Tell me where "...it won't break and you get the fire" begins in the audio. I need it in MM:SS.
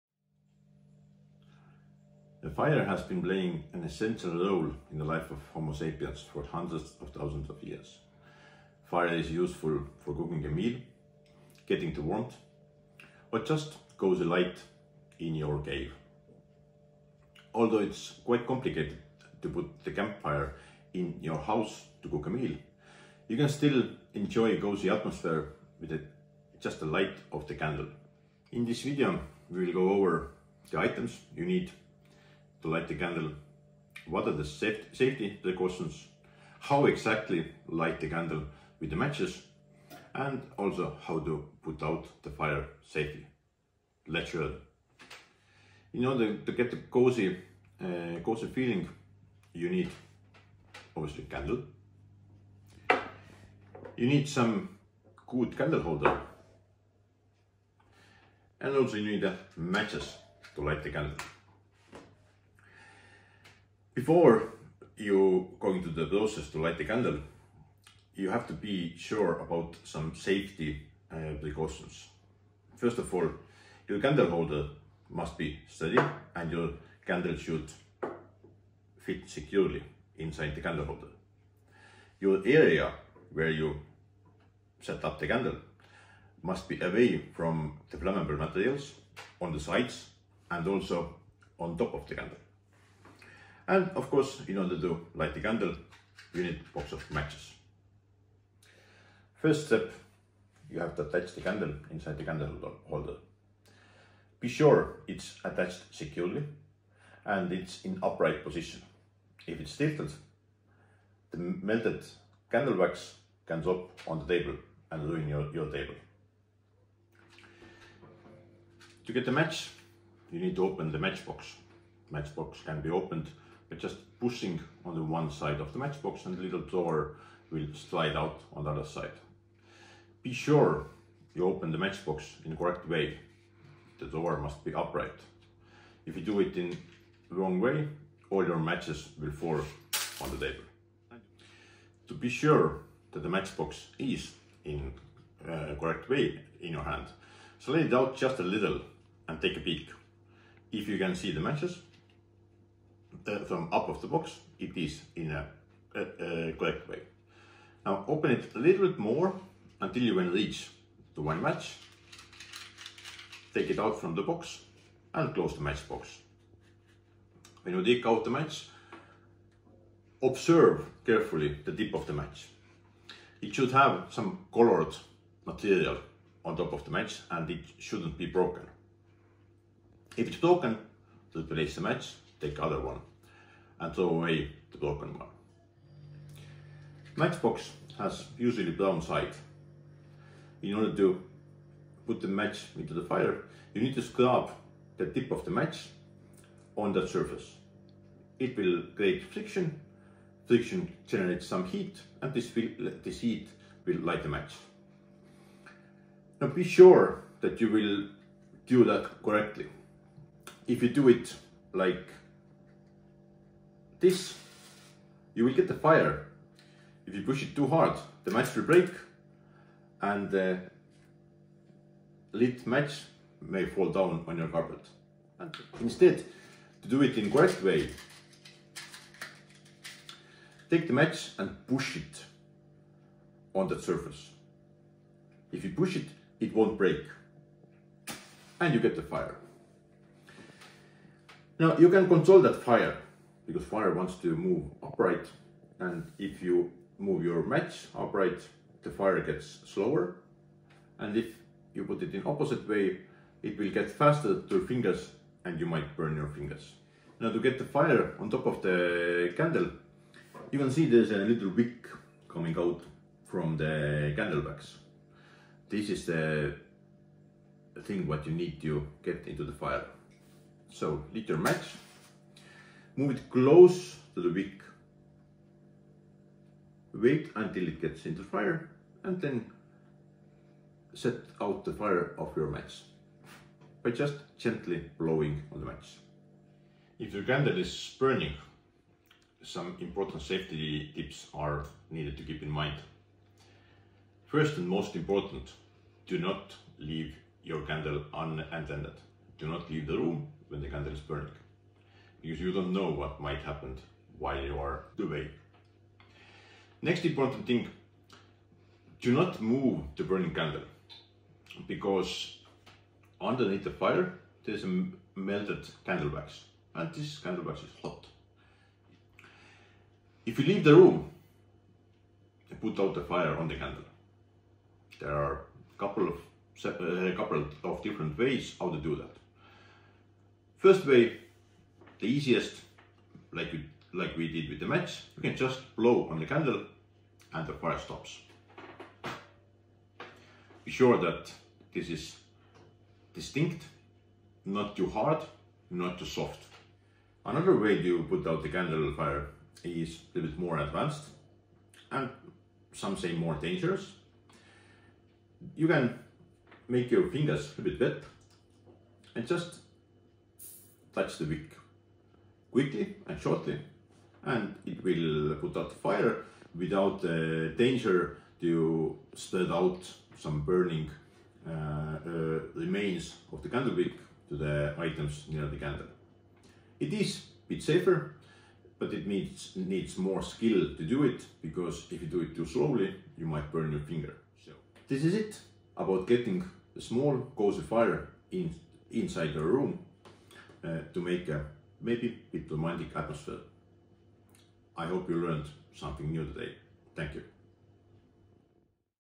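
03:56.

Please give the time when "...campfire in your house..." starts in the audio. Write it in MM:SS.
00:19.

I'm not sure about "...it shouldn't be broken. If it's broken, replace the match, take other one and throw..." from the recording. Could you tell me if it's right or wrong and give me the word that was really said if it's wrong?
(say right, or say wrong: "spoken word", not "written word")
right.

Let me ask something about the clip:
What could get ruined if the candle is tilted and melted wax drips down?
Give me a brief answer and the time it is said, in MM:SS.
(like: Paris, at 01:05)
your table, at 01:55.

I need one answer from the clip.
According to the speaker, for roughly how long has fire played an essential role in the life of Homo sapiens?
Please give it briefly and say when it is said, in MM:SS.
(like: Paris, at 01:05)
hundreds of thousands of years, at 00:06.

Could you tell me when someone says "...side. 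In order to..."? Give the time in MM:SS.
03:09.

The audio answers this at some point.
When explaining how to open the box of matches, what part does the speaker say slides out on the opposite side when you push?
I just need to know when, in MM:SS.
02:06.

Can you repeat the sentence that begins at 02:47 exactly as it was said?
When you take out the match, observe carefully the tip of the match.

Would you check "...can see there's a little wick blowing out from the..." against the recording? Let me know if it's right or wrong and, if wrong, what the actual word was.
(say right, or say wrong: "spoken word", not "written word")
wrong: "coming", not "blowing".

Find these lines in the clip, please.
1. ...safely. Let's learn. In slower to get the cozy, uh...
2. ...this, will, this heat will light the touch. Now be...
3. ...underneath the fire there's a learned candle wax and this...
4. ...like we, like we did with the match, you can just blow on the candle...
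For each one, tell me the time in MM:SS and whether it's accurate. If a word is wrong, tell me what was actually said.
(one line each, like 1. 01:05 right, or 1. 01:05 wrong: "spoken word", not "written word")
1. 00:42 wrong: "order", not "slower"
2. 03:22 wrong: "match", not "touch"
3. 05:13 wrong: "melted", not "learned"
4. 05:33 right.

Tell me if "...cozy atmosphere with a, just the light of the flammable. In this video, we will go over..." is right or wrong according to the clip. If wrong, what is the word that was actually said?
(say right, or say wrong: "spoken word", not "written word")
wrong: "candle", not "flammable".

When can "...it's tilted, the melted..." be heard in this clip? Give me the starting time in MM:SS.
01:49.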